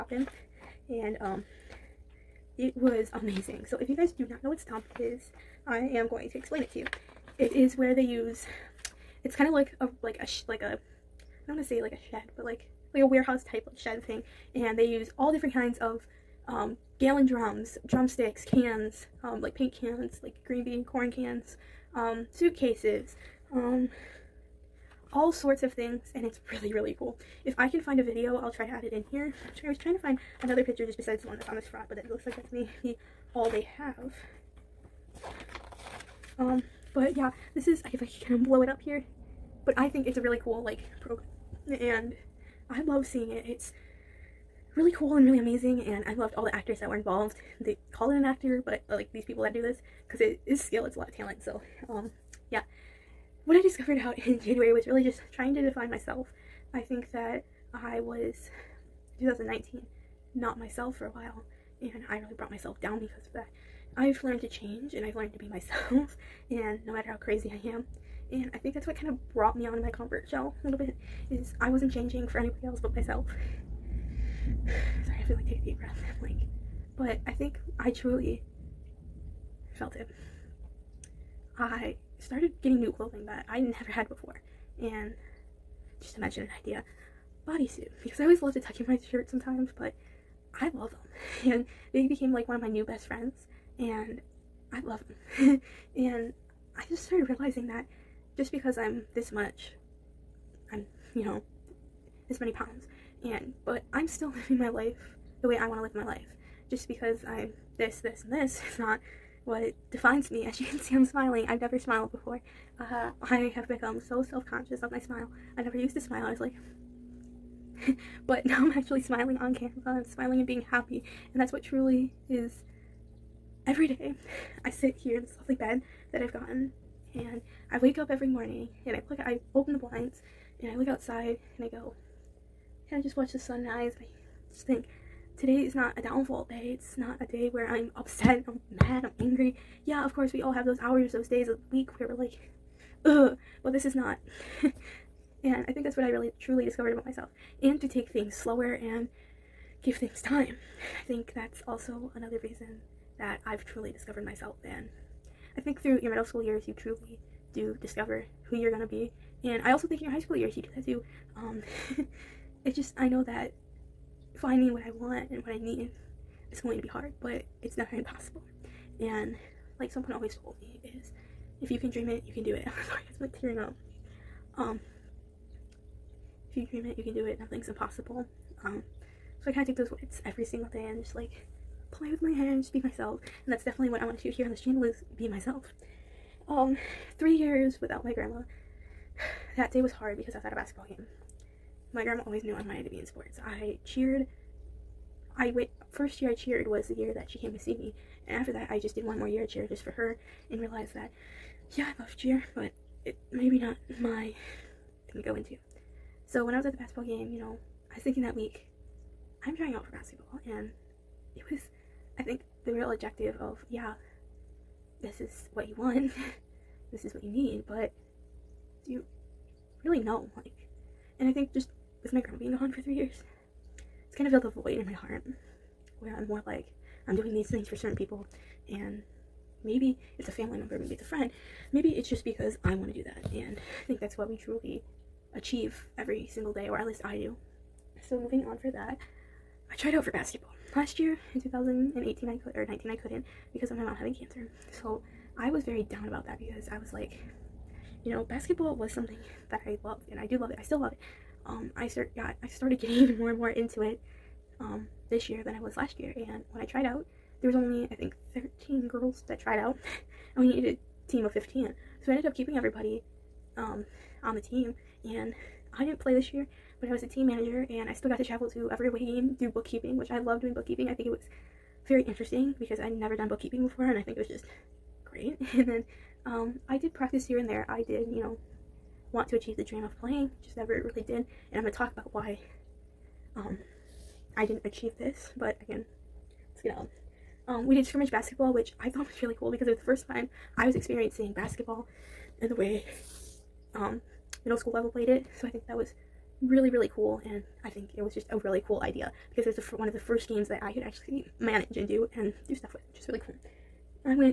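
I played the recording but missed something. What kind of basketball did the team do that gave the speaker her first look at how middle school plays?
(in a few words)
Scrimmage.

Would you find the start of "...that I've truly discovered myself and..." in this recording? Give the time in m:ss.
2:33.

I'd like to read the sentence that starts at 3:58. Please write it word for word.
So, moving on for that, I tried out for basketball.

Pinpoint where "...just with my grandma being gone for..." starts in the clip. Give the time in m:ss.
3:41.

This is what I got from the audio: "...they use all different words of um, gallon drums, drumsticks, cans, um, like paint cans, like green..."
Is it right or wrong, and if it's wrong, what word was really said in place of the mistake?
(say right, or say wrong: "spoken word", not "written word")
wrong: "kinds", not "words".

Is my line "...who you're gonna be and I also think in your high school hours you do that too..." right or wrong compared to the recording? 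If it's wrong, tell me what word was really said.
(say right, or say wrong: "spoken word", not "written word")
wrong: "years", not "hours".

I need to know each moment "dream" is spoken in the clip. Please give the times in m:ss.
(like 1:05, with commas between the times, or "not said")
2:51, 2:56, 4:39.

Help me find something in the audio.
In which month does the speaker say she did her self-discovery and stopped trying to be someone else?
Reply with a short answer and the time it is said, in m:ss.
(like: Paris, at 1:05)
January, at 0:54.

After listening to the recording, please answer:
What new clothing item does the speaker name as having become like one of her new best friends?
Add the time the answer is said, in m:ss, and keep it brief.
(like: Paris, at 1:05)
Bodysuit, at 1:27.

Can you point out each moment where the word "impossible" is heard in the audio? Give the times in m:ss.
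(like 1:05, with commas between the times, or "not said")
2:47, 2:57.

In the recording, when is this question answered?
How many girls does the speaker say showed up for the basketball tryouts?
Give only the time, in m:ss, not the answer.
4:18.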